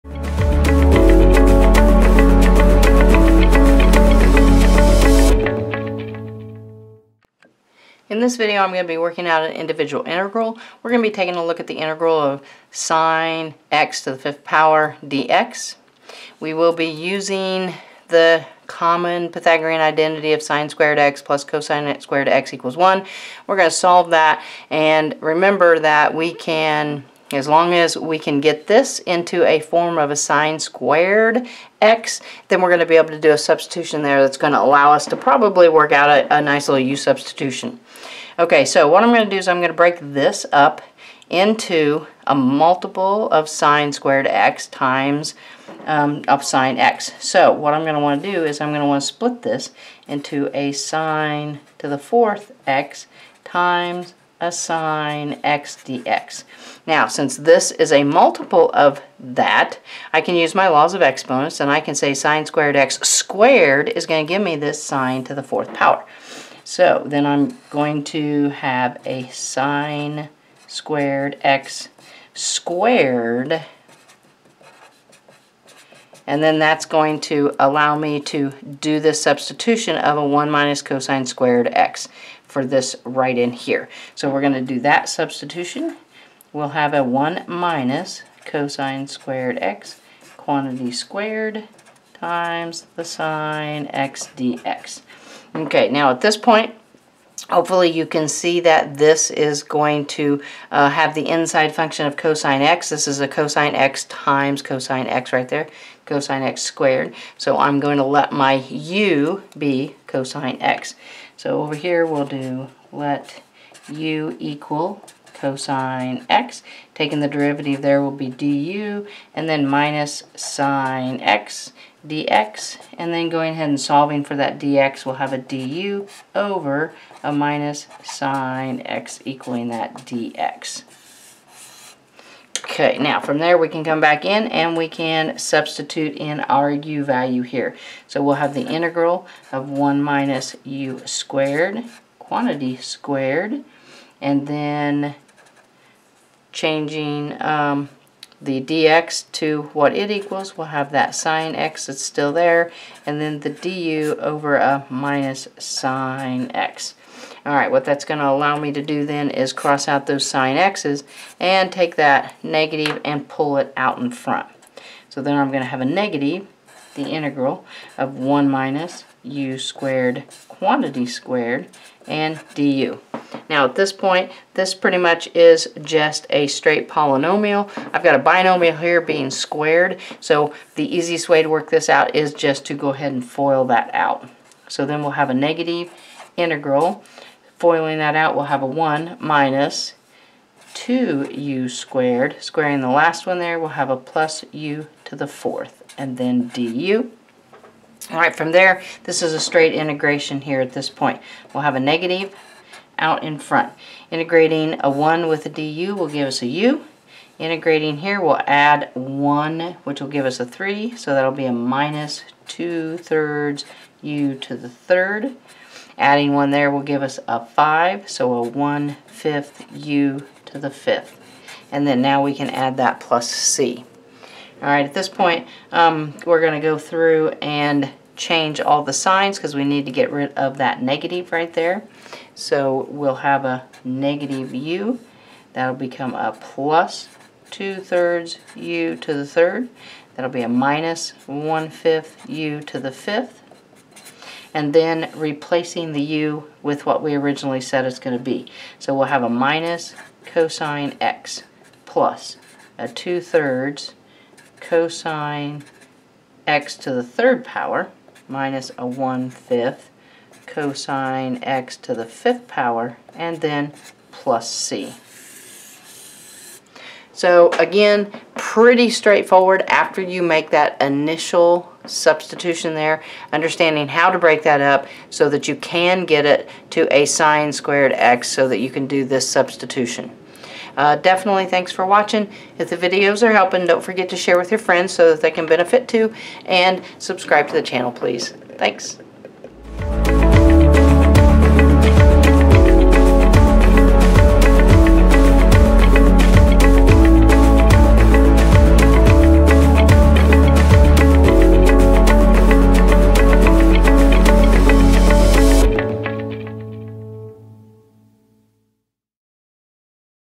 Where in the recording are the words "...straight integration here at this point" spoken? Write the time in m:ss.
3:19.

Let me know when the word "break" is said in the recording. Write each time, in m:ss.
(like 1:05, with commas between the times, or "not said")
0:39, 4:34.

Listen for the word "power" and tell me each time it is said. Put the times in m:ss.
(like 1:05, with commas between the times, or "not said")
0:14, 1:05, 4:17, 4:22.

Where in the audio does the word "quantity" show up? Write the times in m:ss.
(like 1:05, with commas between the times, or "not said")
1:30, 2:22, 2:50.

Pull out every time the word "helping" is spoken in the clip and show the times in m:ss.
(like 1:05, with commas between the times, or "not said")
4:43.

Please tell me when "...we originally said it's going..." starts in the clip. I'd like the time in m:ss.
4:07.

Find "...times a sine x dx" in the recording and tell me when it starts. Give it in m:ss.
0:53.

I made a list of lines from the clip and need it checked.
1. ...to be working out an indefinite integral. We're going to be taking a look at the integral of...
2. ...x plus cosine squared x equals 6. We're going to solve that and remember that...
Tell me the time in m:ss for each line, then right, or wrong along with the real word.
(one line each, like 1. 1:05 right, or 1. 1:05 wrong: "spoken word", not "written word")
1. 0:08 right
2. 0:20 wrong: "1", not "6".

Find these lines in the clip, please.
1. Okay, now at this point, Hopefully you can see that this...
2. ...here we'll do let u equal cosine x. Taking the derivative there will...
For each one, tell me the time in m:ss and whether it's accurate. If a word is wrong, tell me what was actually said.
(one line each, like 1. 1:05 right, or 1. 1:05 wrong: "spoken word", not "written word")
1. 1:35 right
2. 1:51 right.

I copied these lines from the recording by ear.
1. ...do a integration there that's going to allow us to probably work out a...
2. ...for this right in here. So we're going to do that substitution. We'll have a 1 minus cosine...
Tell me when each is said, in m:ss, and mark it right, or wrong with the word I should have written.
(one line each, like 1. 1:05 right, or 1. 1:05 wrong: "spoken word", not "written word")
1. 0:33 wrong: "substitution", not "integration"
2. 1:22 right.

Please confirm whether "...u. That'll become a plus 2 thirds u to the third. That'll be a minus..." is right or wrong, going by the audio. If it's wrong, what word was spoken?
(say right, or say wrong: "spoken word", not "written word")
right.